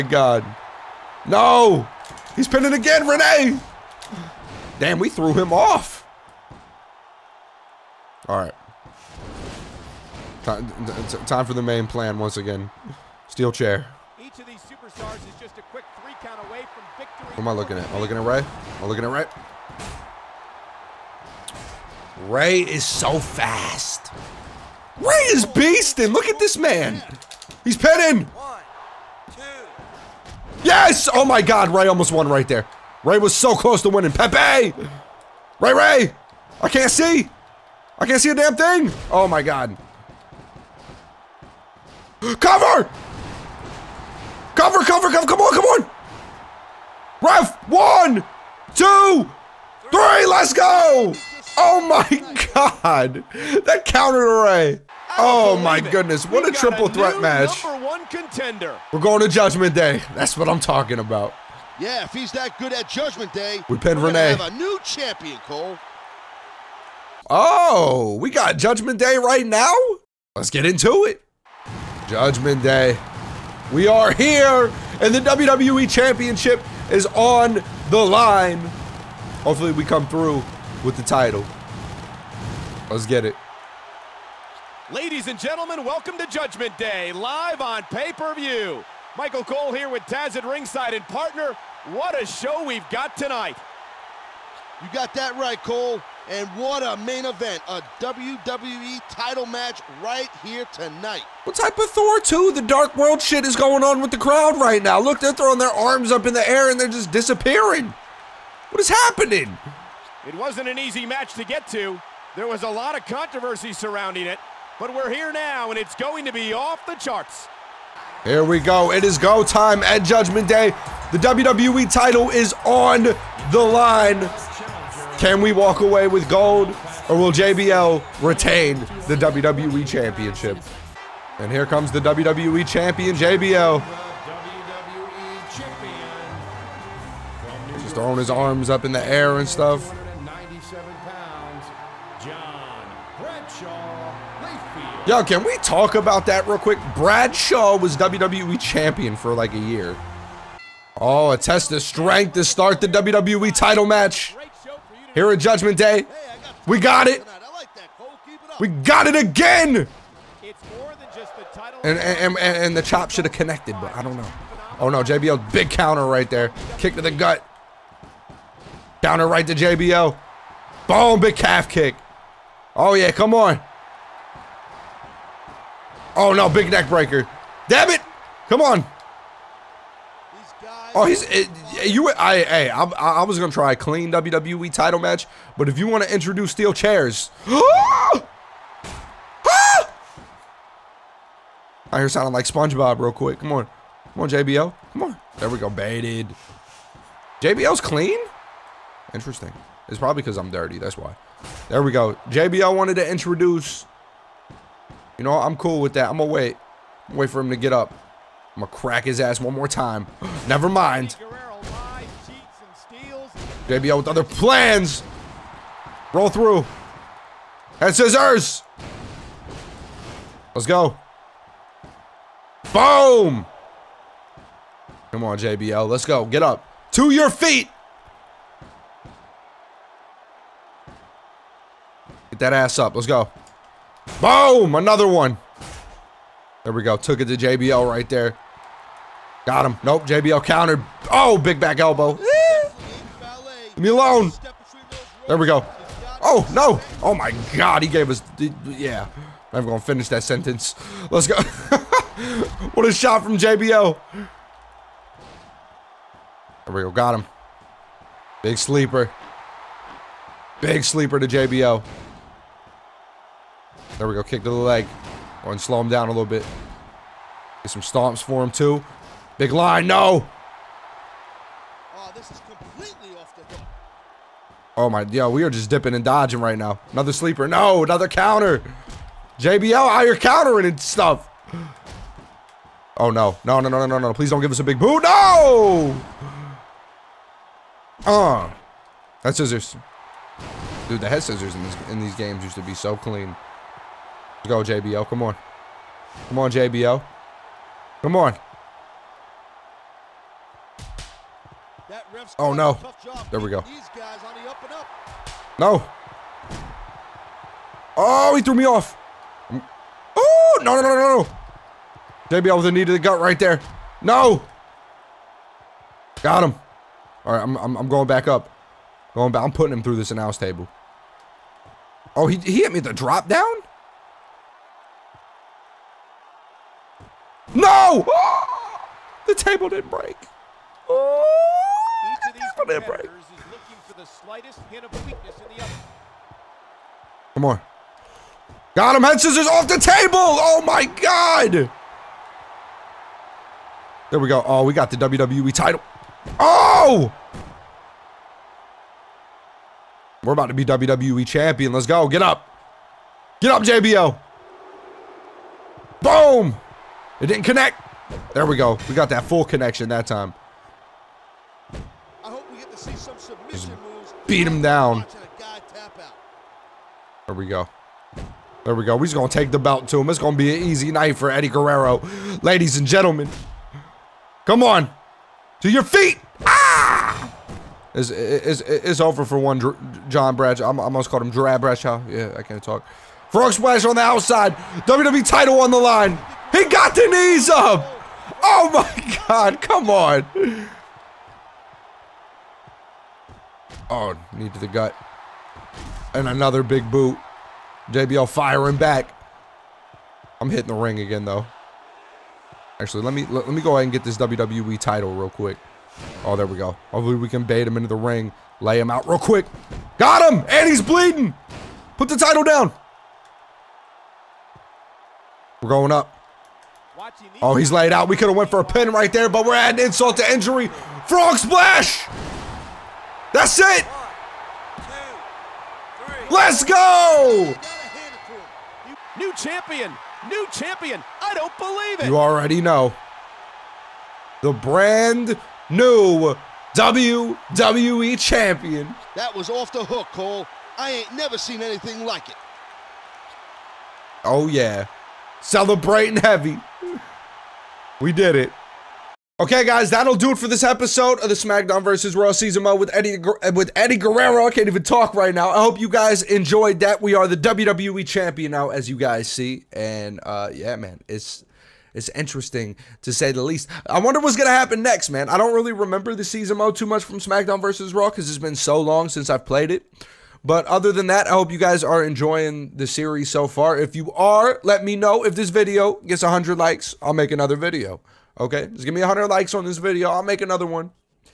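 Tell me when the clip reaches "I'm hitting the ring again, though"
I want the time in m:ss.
6:40.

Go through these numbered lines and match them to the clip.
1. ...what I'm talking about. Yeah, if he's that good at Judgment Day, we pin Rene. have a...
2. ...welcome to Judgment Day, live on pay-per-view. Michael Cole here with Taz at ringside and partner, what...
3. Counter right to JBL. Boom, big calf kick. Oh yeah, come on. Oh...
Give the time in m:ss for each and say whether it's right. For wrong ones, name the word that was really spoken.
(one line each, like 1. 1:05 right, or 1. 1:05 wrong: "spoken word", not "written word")
1. 1:00 right
2. 1:25 right
3. 2:49 right.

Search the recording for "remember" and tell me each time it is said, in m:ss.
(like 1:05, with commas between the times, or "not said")
7:45.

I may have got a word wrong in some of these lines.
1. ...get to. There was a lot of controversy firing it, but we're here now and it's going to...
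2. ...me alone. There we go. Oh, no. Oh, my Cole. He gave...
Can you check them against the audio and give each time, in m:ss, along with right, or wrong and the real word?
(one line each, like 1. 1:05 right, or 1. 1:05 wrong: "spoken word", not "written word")
1. 1:51 wrong: "surrounding", not "firing"
2. 4:03 wrong: "God", not "Cole".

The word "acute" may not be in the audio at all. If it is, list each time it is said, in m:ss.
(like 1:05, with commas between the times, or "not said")
not said.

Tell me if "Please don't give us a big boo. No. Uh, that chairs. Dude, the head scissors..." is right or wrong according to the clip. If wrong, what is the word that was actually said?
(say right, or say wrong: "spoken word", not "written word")
wrong: "scissors", not "chairs".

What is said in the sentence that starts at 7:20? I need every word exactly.
I ain't never seen anything like it.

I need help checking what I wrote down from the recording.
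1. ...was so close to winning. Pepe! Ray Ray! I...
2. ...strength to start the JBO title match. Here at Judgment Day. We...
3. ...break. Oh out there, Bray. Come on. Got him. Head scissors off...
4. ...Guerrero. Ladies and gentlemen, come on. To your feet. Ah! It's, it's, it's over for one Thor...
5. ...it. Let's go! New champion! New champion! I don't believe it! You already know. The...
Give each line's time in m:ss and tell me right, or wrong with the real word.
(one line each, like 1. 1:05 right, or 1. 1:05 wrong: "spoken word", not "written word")
1. 0:33 right
2. 2:31 wrong: "WWE", not "JBO"
3. 5:29 right
4. 6:11 wrong: "John", not "Thor"
5. 7:03 right.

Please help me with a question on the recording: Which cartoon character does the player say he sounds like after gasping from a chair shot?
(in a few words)
SpongeBob.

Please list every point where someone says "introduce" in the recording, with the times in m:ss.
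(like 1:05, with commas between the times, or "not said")
3:06, 3:23.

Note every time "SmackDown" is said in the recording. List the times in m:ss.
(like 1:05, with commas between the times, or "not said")
7:31, 7:47.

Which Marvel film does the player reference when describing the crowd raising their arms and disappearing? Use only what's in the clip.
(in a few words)
Thor 2 the Dark World.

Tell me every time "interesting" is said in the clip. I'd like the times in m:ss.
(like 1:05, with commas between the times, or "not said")
3:19, 7:42.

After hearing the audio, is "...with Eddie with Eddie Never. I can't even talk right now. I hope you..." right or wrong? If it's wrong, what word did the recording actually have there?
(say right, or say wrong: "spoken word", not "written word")
wrong: "Guerrero", not "Never".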